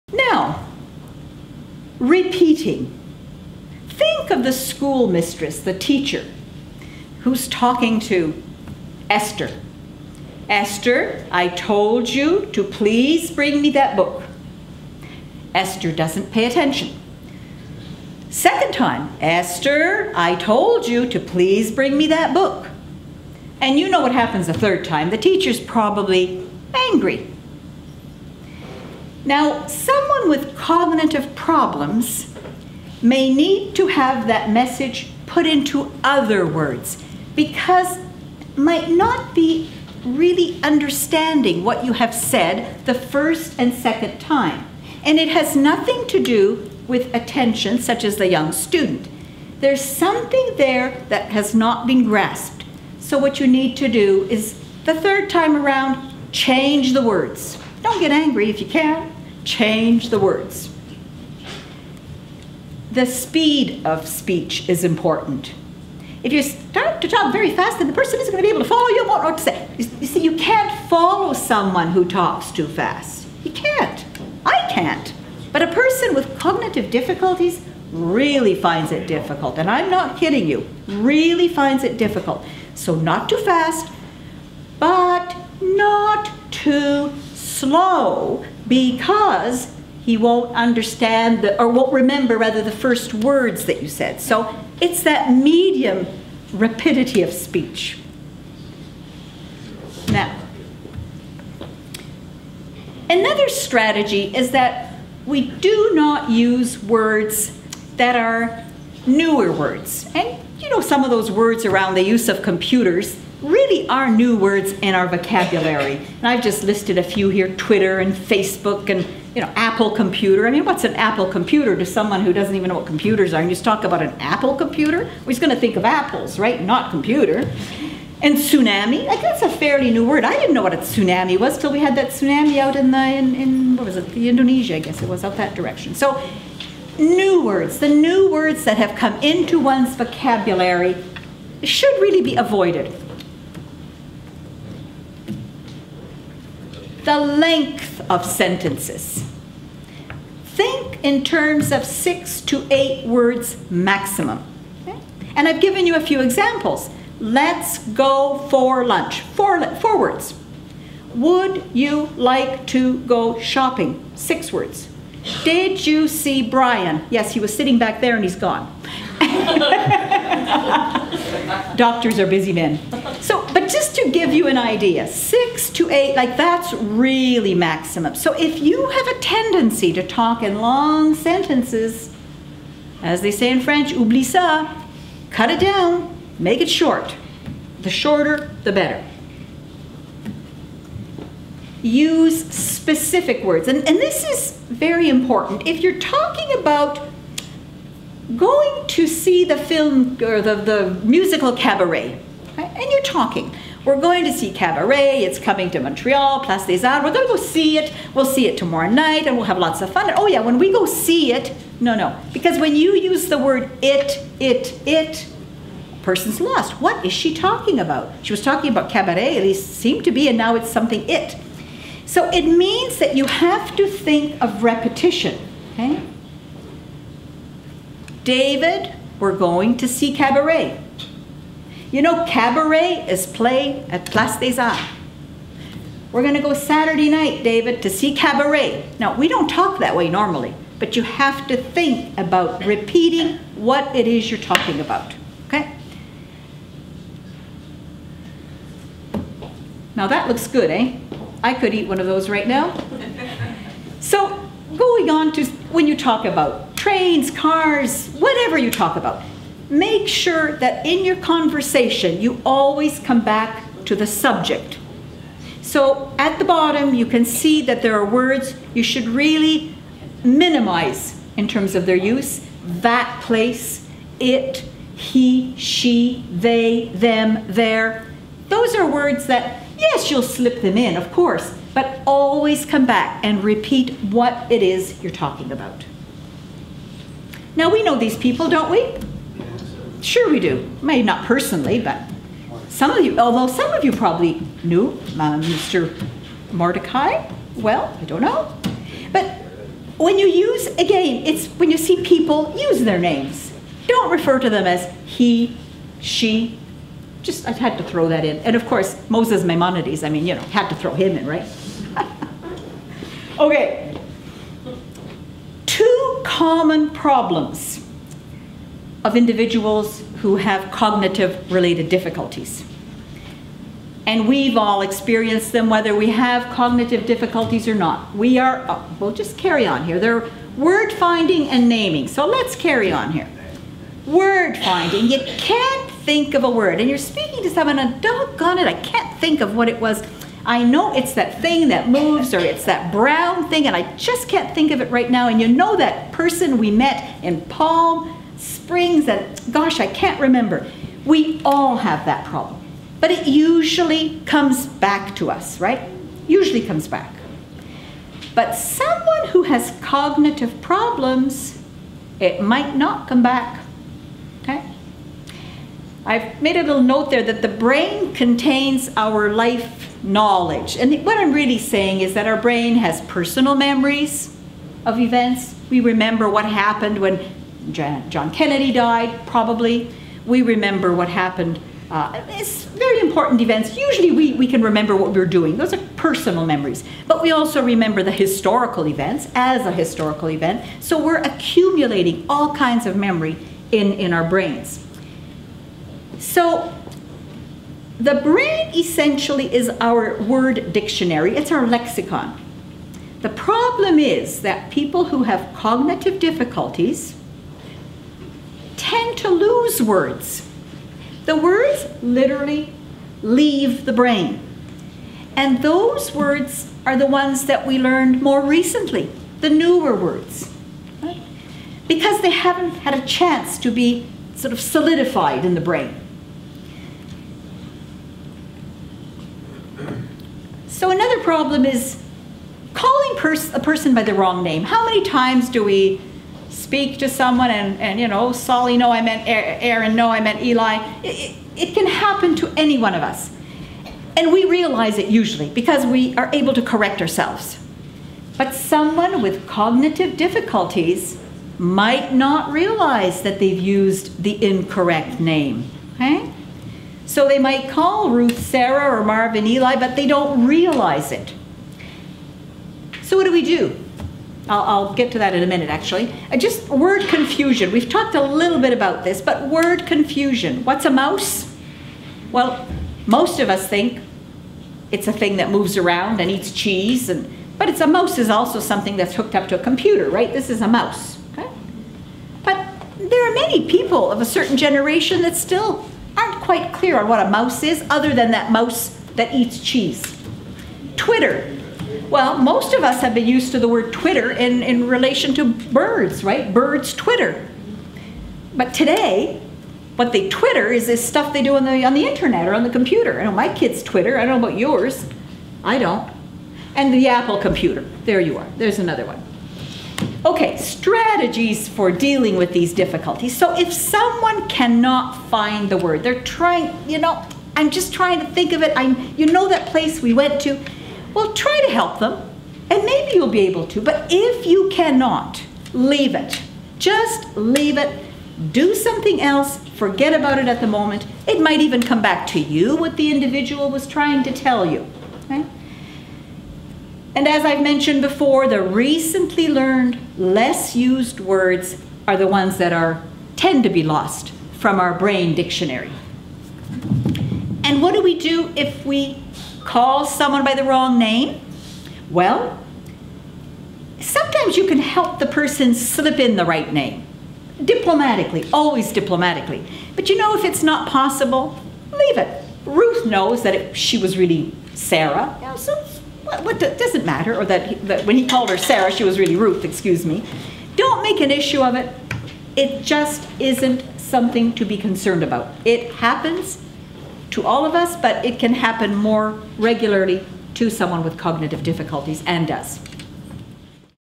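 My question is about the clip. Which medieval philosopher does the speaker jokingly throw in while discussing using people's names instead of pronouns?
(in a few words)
Moses Maimonides.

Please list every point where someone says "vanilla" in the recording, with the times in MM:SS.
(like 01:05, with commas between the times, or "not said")
not said.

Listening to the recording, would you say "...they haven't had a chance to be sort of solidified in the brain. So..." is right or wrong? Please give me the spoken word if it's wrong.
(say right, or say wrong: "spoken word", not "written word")
right.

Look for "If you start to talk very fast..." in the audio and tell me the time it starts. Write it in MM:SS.
01:06.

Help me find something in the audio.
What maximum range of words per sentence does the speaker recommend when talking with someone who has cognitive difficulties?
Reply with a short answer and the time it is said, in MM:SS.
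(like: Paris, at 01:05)
6 to 8 words, at 02:31.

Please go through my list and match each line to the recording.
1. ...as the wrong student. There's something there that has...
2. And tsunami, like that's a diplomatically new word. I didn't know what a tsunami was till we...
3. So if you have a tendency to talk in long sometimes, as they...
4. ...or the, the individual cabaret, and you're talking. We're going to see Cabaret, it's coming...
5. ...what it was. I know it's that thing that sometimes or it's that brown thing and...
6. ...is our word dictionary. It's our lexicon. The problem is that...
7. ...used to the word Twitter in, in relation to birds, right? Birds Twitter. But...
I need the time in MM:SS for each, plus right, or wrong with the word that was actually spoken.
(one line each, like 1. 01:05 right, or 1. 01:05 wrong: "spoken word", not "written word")
1. 00:48 wrong: "young", not "wrong"
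2. 02:08 wrong: "fairly", not "diplomatically"
3. 02:58 wrong: "sentences", not "sometimes"
4. 03:20 wrong: "musical", not "individual"
5. 05:39 wrong: "moves", not "sometimes"
6. 06:39 right
7. 08:13 right.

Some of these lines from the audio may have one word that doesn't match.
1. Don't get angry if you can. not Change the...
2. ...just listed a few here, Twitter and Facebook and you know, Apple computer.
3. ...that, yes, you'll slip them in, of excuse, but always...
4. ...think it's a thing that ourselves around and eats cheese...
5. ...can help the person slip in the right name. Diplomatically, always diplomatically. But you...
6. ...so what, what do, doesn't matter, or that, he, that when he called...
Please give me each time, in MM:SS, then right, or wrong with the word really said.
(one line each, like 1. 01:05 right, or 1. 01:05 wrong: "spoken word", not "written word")
1. 00:57 right
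2. 01:56 right
3. 04:39 wrong: "course", not "excuse"
4. 07:53 wrong: "moves", not "ourselves"
5. 09:14 right
6. 09:25 right.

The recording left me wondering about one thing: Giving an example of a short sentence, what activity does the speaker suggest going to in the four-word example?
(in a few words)
lunch.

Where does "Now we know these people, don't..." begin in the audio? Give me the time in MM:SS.
04:47.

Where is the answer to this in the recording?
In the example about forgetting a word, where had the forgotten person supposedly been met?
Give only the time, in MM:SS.
05:47.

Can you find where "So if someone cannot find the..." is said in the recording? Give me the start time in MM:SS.
08:33.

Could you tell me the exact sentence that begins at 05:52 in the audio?
But it usually comes back to us, right?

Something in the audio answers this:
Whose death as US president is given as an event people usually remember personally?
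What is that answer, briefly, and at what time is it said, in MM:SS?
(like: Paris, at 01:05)
John Kennedy, at 06:17.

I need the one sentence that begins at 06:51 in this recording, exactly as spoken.
The words literally leave the brain.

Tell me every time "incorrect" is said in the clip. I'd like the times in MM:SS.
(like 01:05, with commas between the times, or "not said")
07:34.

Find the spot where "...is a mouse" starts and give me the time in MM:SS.
08:00.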